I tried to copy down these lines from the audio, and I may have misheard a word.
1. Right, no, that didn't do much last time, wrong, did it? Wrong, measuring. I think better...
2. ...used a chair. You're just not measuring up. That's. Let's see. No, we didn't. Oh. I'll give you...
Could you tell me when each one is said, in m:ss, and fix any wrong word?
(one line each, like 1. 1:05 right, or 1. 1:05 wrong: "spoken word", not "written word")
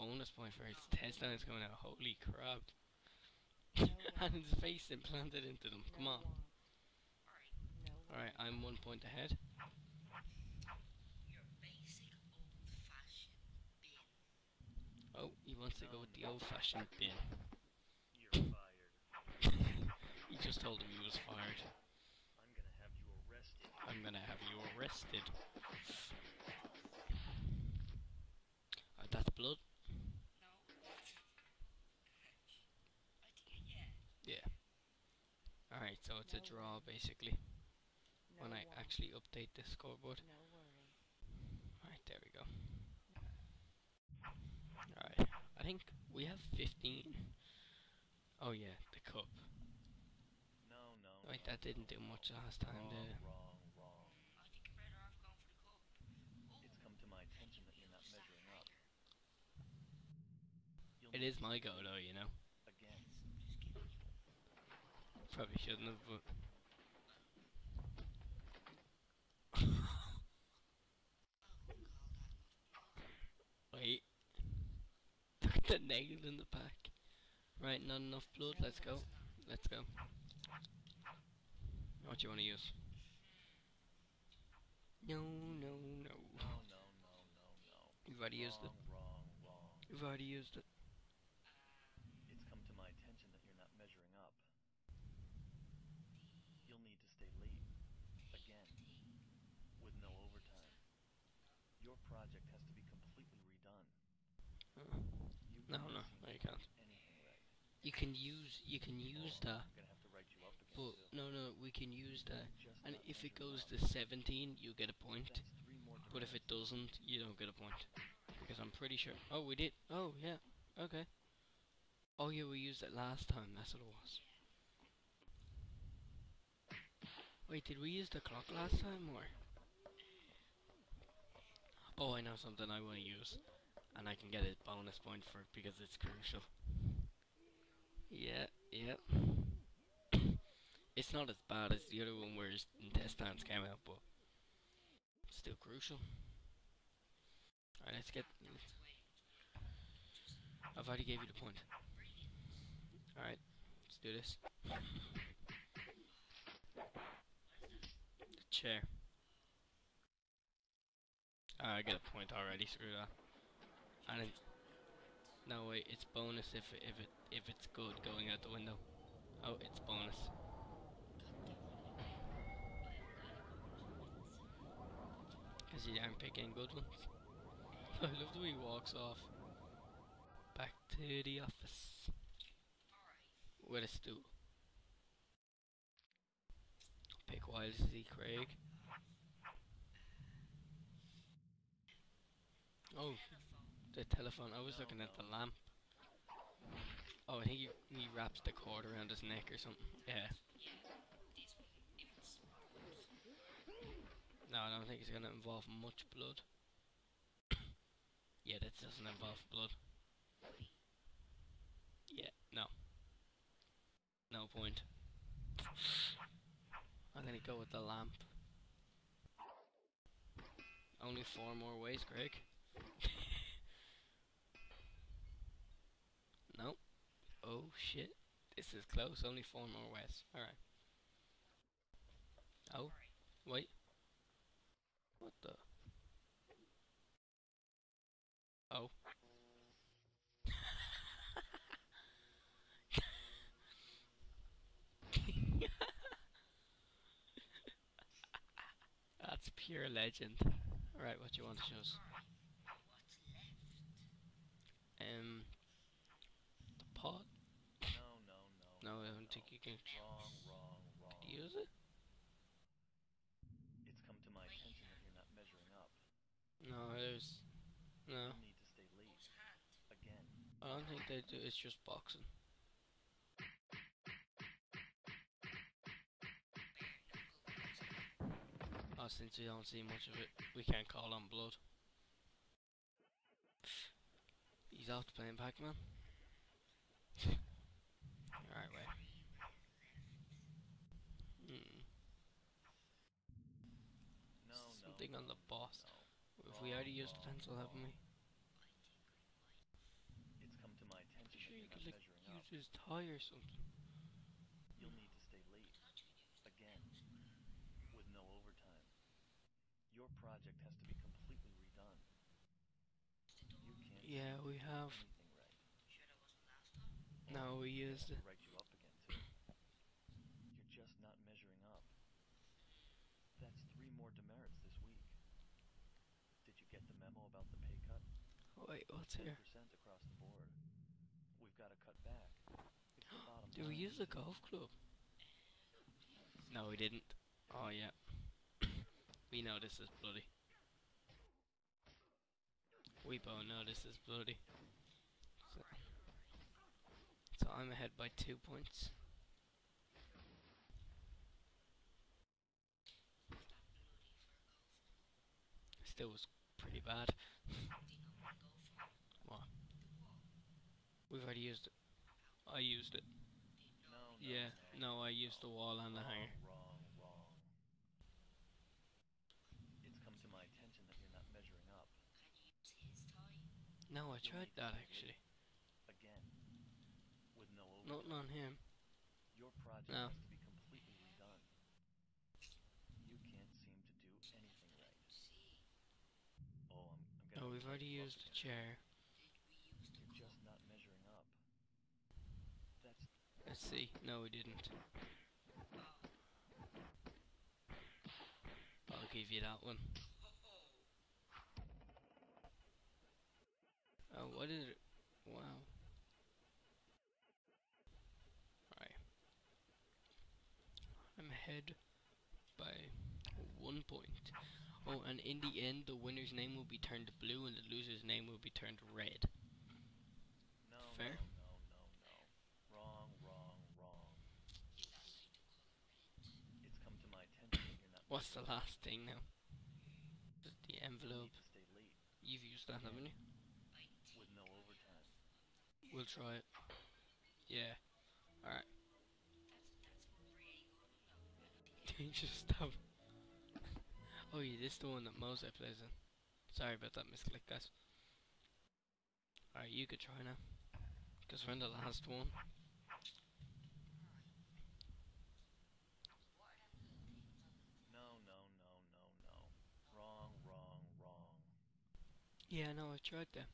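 1. 0:51 wrong: "wrong", not "measuring"
2. 6:27 right.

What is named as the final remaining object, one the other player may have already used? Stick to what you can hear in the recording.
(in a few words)
envelope.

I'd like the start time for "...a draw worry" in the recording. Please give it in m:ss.
0:36.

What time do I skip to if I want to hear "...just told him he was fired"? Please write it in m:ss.
0:20.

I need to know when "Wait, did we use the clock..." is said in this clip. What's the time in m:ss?
2:07.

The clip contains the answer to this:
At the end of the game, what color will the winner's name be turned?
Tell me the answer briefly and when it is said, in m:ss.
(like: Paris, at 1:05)
blue, at 6:57.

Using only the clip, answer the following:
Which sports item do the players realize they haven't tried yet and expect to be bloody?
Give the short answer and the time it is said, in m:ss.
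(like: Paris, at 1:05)
golf club, at 5:33.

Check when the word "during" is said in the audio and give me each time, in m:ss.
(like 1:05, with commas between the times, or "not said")
not said.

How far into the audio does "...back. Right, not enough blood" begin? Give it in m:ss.
1:16.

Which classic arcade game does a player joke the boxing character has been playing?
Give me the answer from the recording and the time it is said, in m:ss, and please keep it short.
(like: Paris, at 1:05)
Pac-Man, at 4:45.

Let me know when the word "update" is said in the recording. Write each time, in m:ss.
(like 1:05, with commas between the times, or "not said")
0:39.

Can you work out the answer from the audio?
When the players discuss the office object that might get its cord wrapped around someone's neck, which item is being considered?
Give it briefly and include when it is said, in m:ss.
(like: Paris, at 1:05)
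telephone, at 3:13.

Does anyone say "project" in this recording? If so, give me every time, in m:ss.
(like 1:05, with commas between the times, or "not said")
1:41, 5:10, 6:19.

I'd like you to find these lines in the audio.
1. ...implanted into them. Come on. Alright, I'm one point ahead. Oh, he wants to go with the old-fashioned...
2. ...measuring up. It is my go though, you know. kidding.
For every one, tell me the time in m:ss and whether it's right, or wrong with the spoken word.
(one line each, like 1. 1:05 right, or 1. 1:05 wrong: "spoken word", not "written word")
1. 0:04 right
2. 0:58 right.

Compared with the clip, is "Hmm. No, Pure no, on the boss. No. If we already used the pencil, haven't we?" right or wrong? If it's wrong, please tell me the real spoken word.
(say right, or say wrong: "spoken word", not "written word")
wrong: "Something", not "Pure".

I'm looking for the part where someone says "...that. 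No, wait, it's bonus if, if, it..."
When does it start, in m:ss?
2:42.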